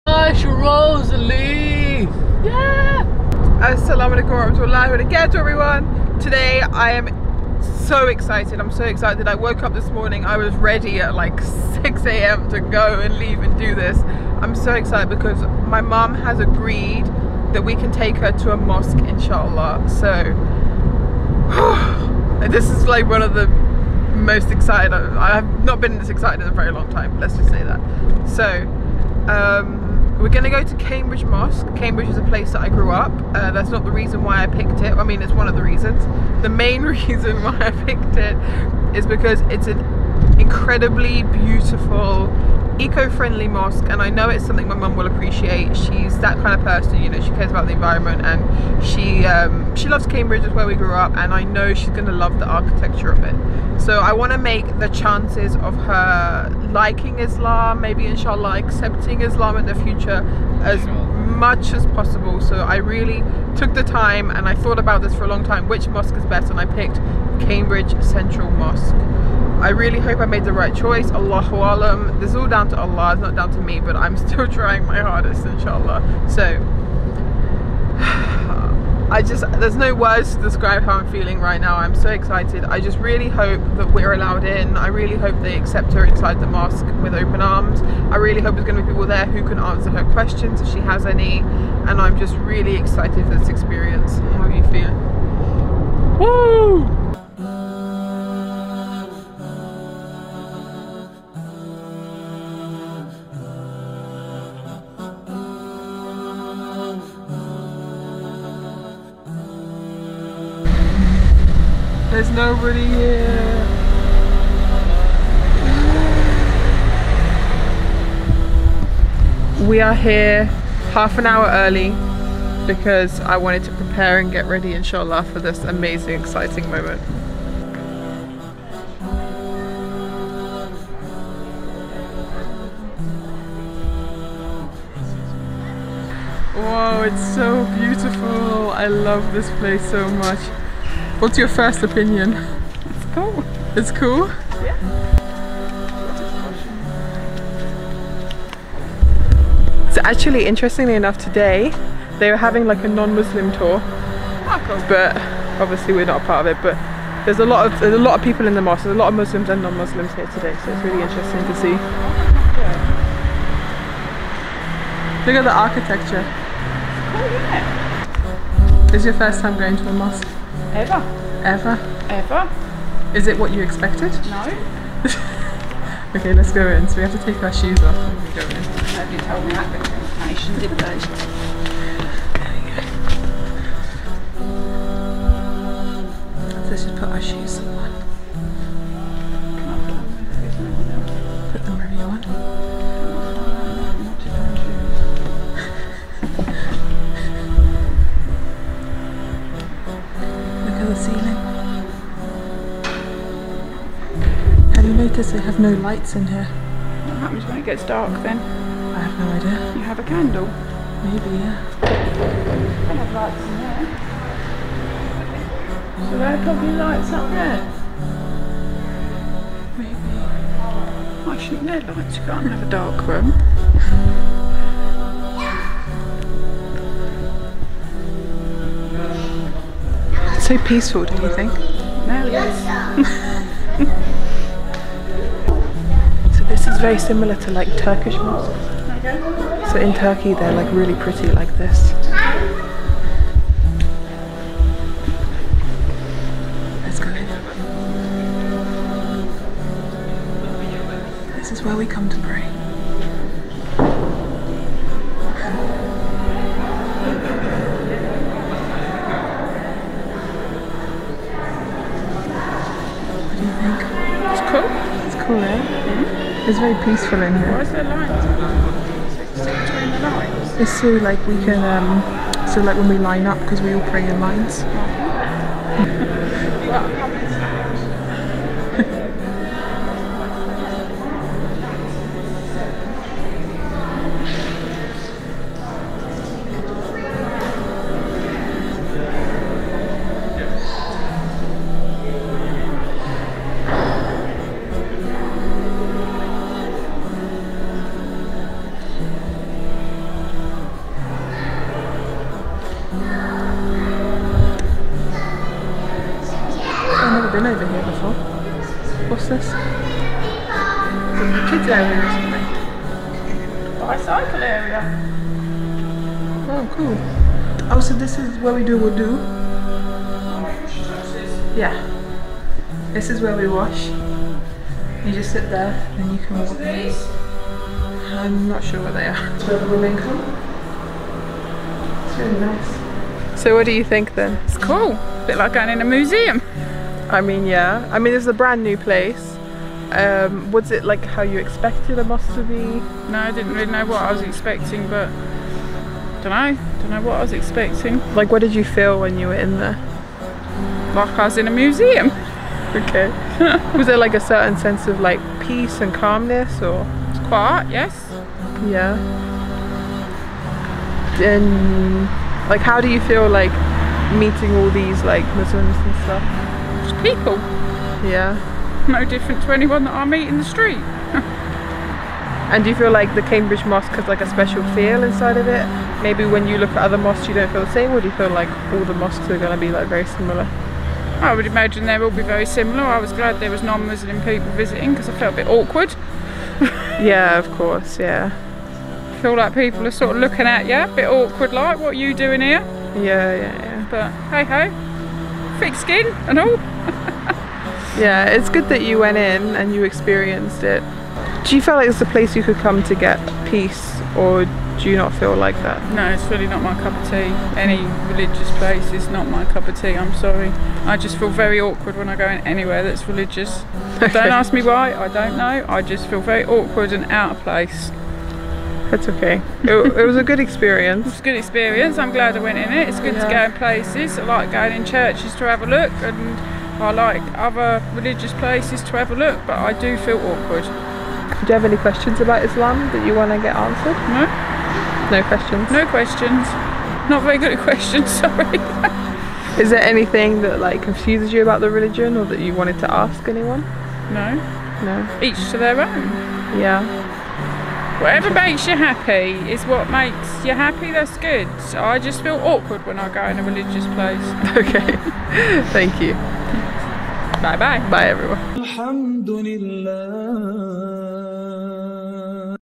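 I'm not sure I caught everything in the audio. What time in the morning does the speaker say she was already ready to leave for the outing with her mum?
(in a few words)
6 a.m.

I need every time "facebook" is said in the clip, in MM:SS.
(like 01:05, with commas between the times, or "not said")
not said.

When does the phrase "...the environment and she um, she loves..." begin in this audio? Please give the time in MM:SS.
00:47.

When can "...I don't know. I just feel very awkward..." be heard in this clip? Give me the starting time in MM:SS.
06:54.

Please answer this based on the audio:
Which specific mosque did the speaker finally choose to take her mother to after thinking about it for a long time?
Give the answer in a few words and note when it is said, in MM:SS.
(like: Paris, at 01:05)
Cambridge Central Mosque, at 01:07.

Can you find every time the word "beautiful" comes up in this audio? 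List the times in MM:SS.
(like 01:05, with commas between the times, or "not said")
00:41, 02:17.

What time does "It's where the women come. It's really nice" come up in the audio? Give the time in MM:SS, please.
05:29.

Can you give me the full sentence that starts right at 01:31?
And I'm just really excited for this experience.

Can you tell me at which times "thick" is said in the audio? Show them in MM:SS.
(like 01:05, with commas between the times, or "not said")
06:35.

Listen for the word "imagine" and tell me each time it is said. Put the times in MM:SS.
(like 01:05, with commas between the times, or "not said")
06:21.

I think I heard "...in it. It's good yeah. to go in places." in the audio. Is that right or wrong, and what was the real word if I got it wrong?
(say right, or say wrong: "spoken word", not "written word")
right.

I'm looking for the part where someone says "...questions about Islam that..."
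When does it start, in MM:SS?
07:11.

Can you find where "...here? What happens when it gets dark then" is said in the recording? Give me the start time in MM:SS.
03:26.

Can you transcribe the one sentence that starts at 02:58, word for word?
Nobody told me that information, did they?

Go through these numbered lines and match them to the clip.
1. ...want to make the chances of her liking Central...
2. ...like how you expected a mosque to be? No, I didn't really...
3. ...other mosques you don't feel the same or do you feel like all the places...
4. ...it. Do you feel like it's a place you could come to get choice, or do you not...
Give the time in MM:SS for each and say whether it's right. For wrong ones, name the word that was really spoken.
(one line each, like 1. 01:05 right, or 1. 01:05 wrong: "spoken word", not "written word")
1. 00:54 wrong: "Islam", not "Central"
2. 05:40 right
3. 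06:16 wrong: "mosques", not "places"
4. 06:40 wrong: "peace", not "choice".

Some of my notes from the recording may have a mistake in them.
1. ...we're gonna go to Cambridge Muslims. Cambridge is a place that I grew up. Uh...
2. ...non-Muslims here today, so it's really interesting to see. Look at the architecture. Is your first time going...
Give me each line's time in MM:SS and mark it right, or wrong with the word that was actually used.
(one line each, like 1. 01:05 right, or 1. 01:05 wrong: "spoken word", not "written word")
1. 00:30 wrong: "Mosque", not "Muslims"
2. 02:39 right.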